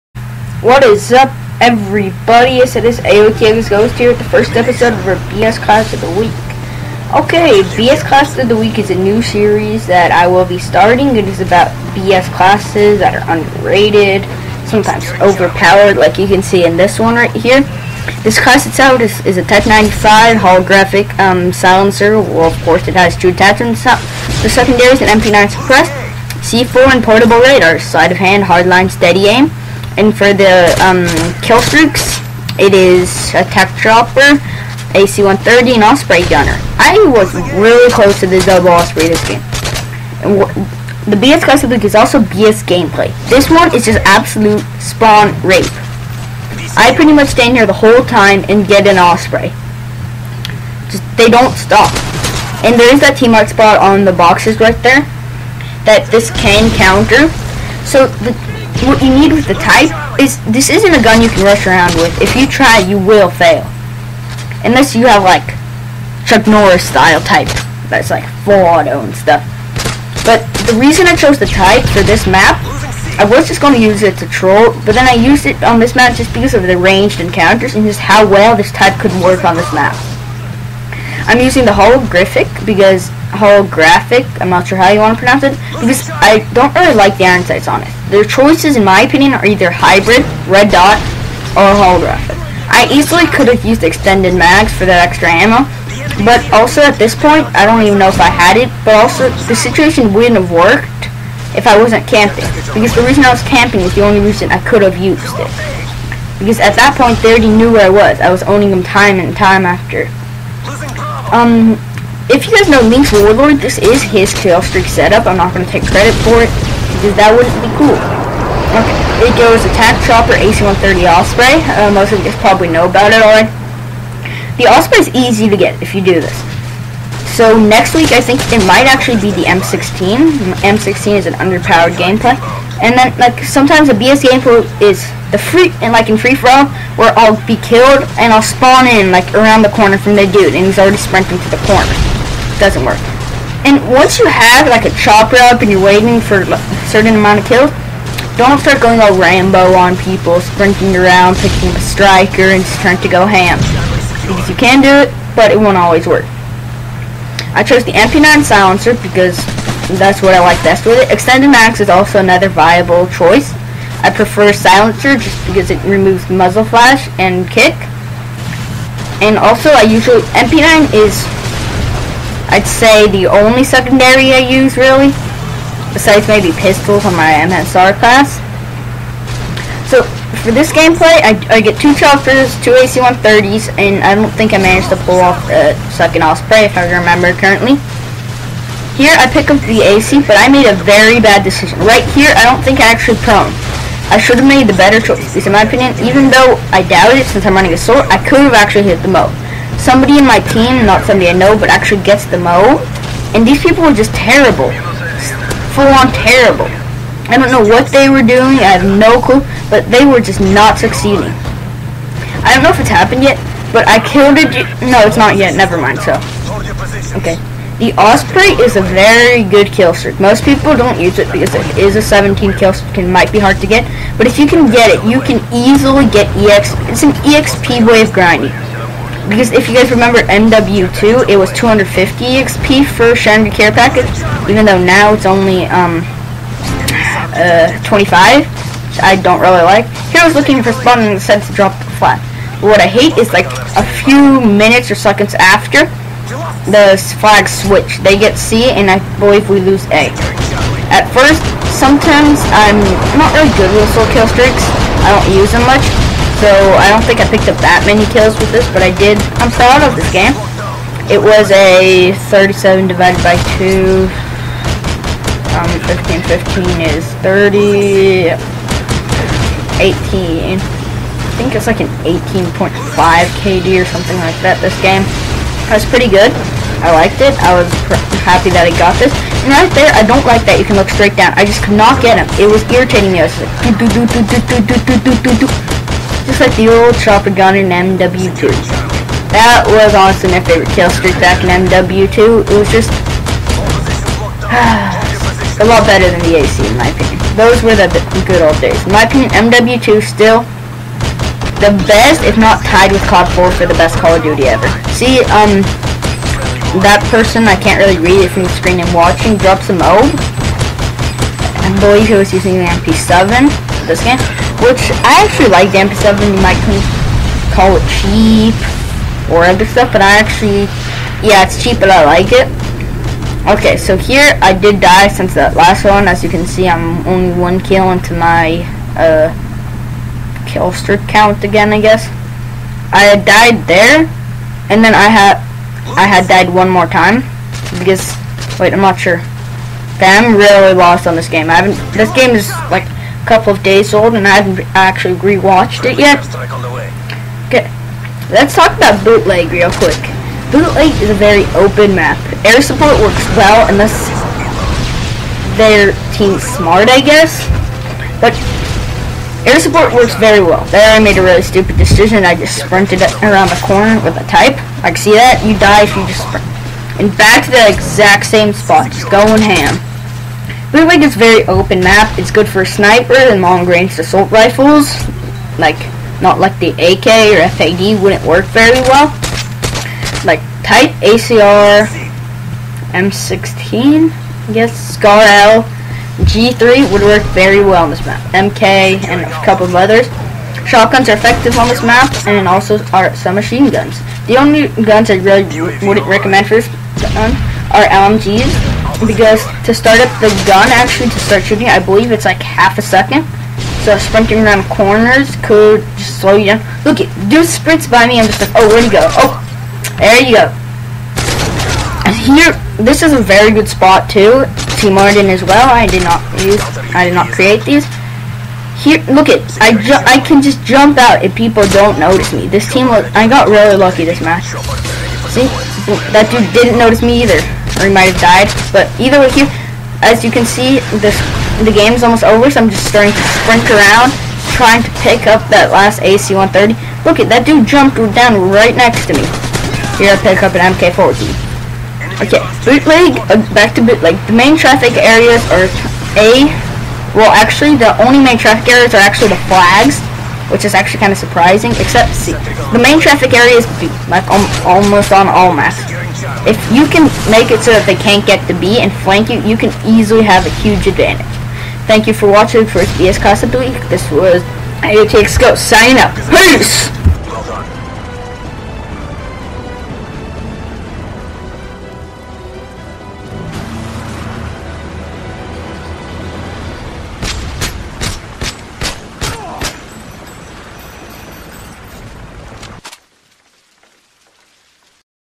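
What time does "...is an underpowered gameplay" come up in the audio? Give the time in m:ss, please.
2:11.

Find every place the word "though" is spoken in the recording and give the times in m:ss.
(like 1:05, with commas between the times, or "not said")
3:16, 3:54.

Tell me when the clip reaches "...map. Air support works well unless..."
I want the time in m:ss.
5:51.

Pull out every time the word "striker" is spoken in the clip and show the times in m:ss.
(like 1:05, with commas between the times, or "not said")
2:31.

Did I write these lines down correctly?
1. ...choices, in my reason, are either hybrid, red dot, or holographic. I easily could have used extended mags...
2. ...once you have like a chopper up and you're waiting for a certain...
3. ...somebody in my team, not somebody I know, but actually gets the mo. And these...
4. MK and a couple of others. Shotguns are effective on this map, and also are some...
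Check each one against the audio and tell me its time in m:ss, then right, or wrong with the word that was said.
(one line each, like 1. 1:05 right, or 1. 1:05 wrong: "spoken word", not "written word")
1. 1:28 wrong: "opinion", not "reason"
2. 2:23 right
3. 3:19 right
4. 6:28 right.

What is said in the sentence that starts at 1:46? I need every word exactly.
Because at that point, they already knew where I was.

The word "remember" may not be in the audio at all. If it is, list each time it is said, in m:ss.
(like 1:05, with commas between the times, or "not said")
3:06, 3:49.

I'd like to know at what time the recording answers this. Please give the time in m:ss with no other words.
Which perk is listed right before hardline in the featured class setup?
0:27.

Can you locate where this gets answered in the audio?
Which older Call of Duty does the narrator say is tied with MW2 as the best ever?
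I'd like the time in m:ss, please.
5:03.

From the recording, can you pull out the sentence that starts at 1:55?
I'm not going to take credit for it, because that wouldn't be cool.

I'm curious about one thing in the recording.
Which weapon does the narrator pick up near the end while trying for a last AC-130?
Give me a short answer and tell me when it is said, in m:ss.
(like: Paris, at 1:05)
MK-14, at 7:20.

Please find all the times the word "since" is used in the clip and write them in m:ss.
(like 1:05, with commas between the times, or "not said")
3:17, 5:25.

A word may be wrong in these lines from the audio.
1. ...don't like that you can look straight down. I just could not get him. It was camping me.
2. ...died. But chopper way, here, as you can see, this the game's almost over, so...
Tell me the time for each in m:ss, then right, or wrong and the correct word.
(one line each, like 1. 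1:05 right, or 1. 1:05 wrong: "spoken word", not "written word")
1. 4:40 wrong: "irritating", not "camping"
2. 7:08 wrong: "either", not "chopper".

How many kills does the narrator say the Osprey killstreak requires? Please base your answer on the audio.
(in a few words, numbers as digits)
17.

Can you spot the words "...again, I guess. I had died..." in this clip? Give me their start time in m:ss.
5:31.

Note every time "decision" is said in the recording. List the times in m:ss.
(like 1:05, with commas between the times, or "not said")
3:11, 6:01.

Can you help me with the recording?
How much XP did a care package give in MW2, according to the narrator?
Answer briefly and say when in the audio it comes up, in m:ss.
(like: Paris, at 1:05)
250, at 3:51.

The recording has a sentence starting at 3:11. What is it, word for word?
Right here, I don't think I actually prone.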